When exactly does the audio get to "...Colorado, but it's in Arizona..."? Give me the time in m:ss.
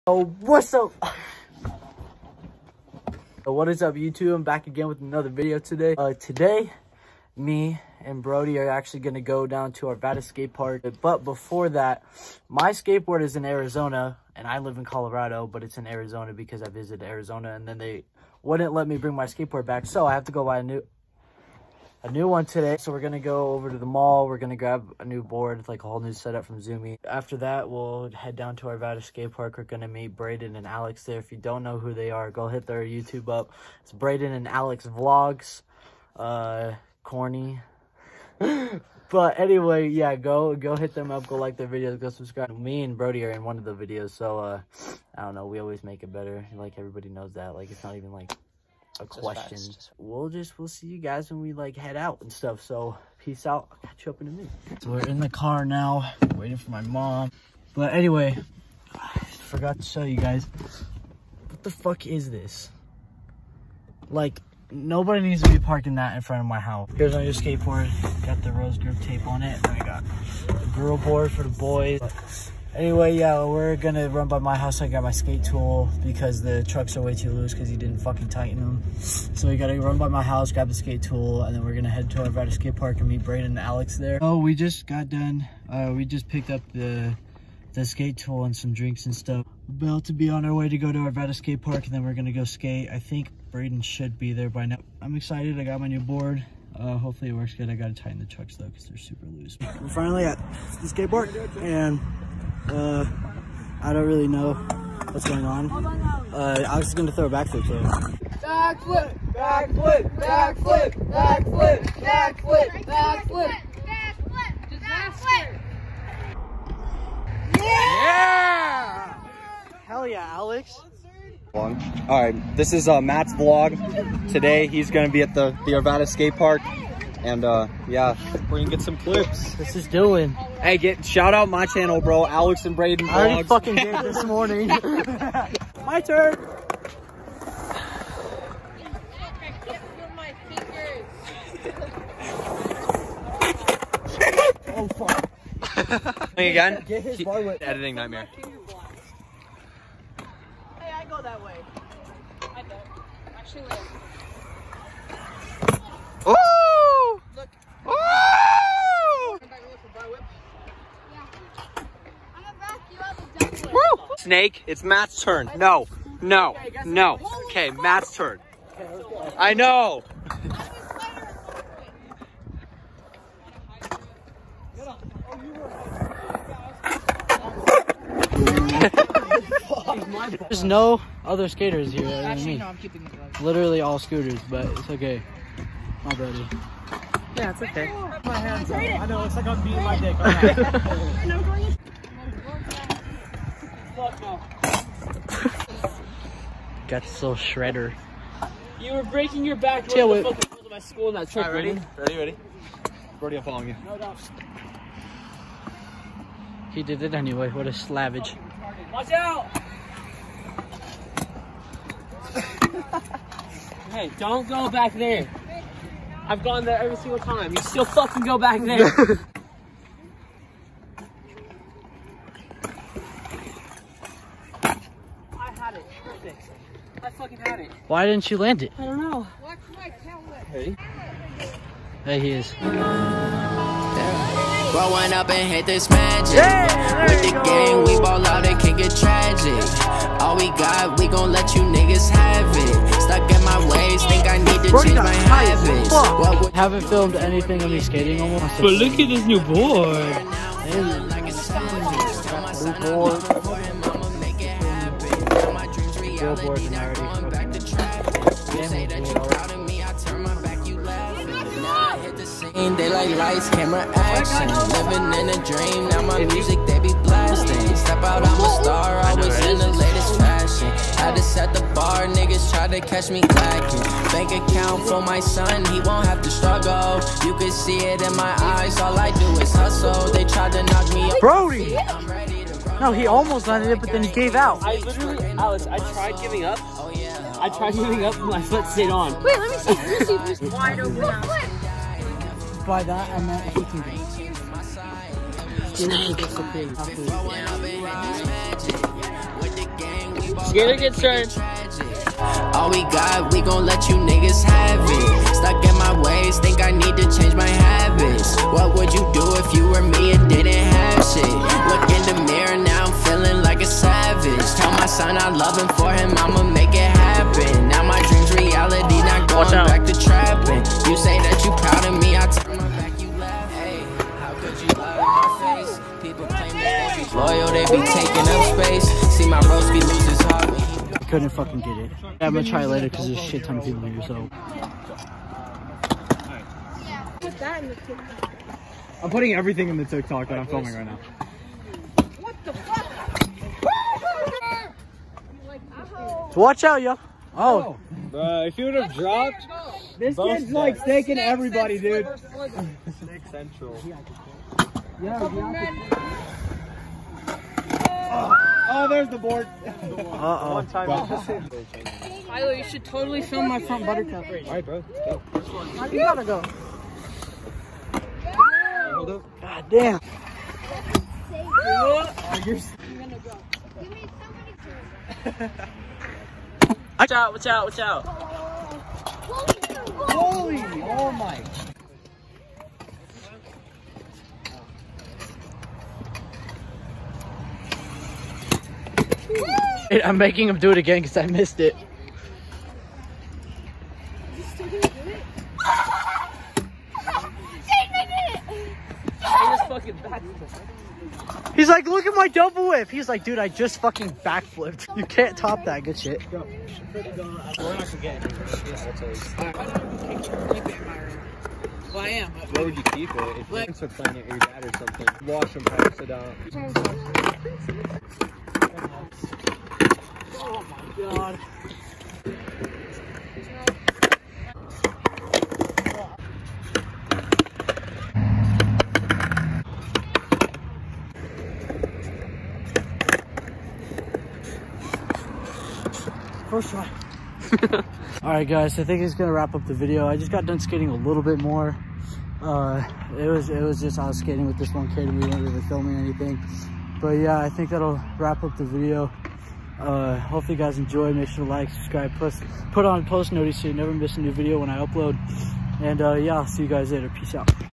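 0:14.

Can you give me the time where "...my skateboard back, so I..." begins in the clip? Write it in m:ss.
0:19.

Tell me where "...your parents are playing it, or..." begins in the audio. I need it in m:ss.
6:53.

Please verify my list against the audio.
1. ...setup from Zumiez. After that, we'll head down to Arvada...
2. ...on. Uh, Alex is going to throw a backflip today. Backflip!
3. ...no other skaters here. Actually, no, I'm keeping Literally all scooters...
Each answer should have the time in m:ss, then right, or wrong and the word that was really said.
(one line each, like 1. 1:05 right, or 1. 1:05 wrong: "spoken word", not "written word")
1. 0:26 right
2. 1:45 right
3. 3:00 right.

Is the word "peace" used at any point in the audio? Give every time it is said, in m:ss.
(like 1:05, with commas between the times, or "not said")
0:53, 7:37.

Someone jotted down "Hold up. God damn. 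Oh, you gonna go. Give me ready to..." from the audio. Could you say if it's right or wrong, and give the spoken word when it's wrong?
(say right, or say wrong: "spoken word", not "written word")
wrong: "somebody", not "ready".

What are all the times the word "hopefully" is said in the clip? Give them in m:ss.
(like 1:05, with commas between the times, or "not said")
1:36, 7:30.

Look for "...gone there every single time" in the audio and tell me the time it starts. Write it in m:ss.
3:36.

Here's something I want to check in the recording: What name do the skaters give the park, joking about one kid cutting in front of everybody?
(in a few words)
Snake Central.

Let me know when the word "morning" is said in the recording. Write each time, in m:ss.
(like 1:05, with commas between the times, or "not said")
2:14.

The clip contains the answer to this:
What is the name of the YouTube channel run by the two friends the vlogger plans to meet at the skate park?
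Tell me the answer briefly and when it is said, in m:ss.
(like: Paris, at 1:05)
Braden and Alex Vlogs, at 0:33.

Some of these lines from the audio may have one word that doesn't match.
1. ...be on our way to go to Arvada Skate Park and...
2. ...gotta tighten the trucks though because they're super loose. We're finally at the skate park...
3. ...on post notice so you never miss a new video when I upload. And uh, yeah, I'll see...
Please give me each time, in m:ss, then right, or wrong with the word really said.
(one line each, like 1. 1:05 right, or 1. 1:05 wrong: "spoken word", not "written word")
1. 1:30 right
2. 1:37 right
3. 7:32 right.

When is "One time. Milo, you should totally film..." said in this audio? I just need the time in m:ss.
6:00.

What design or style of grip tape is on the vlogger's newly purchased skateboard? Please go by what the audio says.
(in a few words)
Rose.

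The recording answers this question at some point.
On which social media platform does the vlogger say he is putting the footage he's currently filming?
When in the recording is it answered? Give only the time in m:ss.
5:39.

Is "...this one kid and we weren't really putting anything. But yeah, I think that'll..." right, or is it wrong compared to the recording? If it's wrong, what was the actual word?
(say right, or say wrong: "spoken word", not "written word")
wrong: "filming", not "putting".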